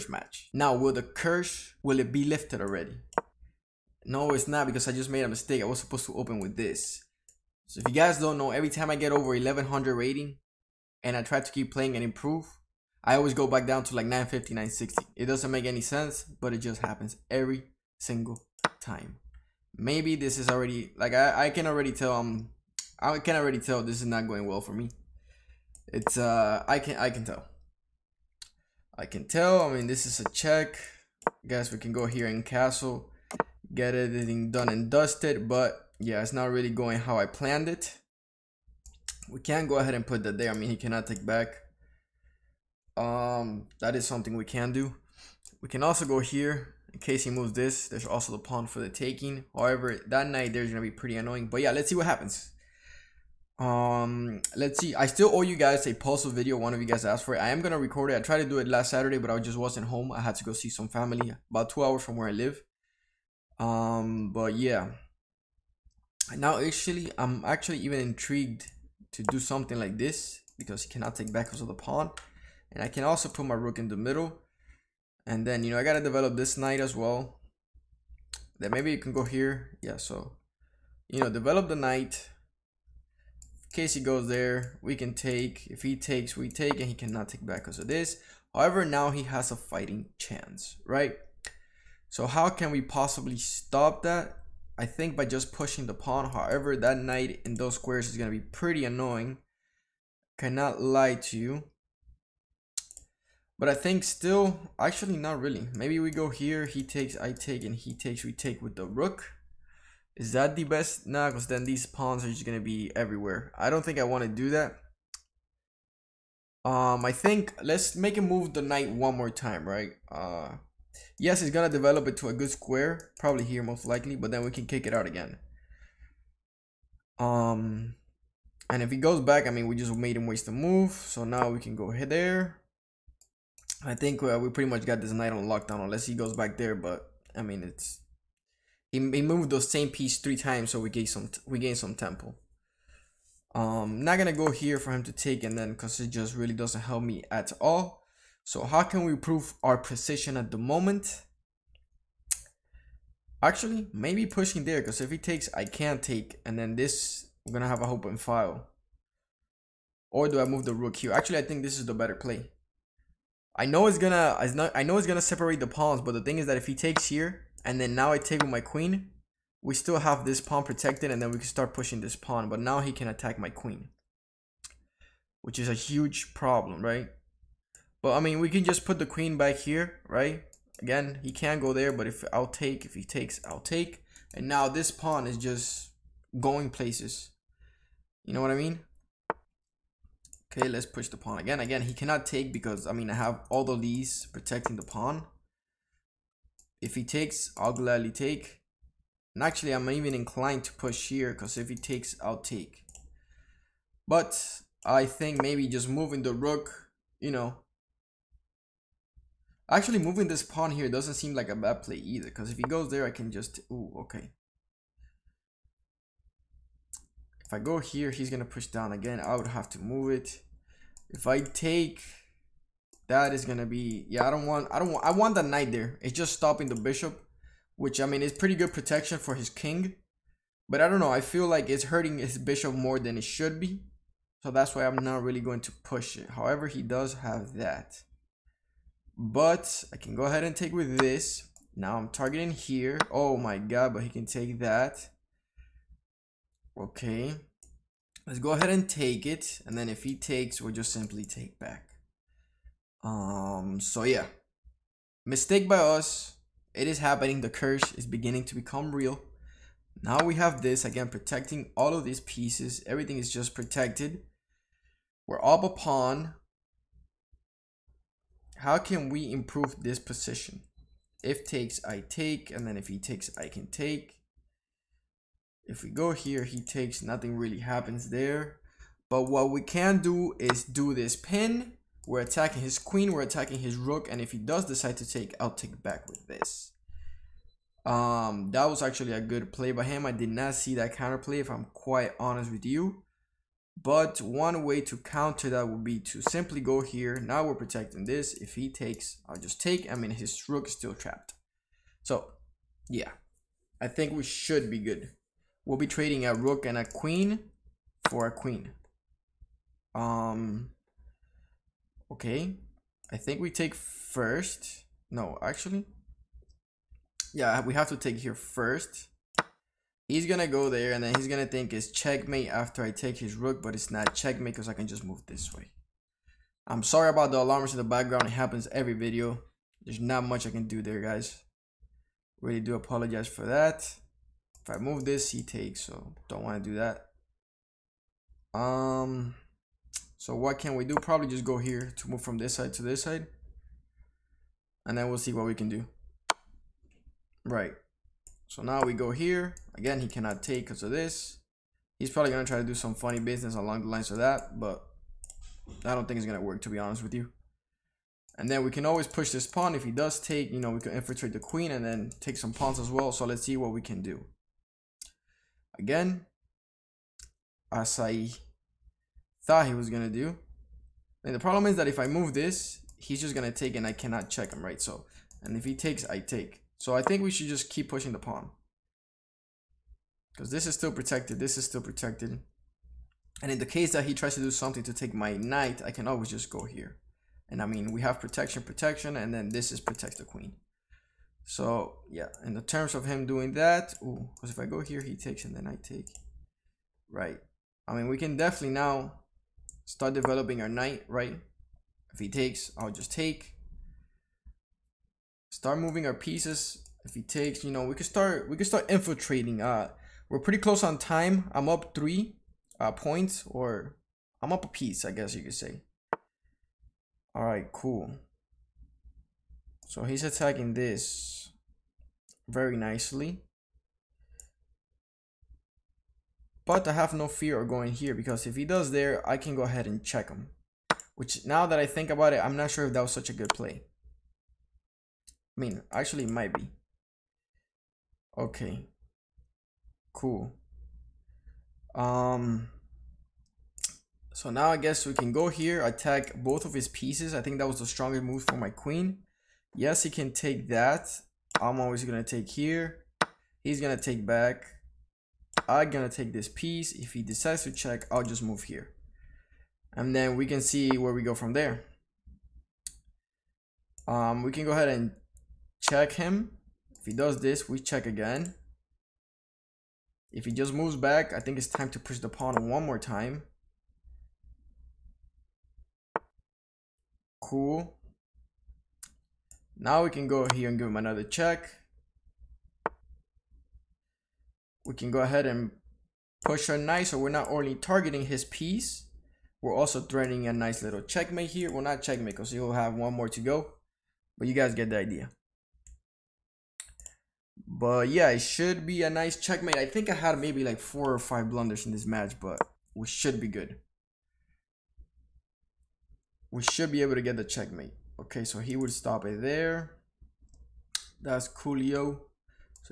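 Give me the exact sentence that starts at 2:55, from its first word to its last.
Which is a huge problem, right?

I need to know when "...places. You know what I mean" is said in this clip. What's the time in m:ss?
3:06.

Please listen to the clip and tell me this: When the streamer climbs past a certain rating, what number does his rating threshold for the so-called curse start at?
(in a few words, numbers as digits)
1100.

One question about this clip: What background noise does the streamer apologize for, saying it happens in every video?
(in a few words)
Alarms.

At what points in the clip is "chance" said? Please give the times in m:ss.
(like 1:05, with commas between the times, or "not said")
1:30.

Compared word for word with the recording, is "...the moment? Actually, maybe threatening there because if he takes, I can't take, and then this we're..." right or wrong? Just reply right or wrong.
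wrong.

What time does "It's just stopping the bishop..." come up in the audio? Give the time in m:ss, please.
3:46.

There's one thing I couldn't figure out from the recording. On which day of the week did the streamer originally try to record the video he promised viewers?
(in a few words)
Saturday.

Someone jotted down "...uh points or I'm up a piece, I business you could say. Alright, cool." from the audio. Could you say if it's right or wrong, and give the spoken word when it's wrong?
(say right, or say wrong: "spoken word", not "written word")
wrong: "guess", not "business".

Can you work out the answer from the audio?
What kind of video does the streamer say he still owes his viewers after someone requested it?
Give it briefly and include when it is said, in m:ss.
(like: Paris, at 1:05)
Puzzle video, at 0:55.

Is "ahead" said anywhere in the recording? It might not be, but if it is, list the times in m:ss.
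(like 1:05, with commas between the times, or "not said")
0:39, 2:11, 4:00, 4:08, 7:09, 7:44, 8:05.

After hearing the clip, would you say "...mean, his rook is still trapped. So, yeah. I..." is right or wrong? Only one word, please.
right.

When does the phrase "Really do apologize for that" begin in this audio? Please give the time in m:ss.
5:32.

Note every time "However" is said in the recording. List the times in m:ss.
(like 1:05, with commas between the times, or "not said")
0:49, 1:28, 1:36, 3:56.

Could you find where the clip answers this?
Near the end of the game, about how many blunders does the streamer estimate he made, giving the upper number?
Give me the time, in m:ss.
8:21.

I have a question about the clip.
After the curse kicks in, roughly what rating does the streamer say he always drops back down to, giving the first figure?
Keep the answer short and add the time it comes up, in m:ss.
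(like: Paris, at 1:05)
950, at 0:14.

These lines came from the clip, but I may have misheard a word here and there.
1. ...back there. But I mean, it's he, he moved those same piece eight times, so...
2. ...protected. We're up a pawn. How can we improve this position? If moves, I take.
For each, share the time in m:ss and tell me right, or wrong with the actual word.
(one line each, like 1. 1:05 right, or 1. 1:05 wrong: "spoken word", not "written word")
1. 2:16 wrong: "three", not "eight"
2. 4:23 wrong: "takes", not "moves".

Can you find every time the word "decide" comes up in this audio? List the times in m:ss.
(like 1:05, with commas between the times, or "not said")
4:44, 7:37.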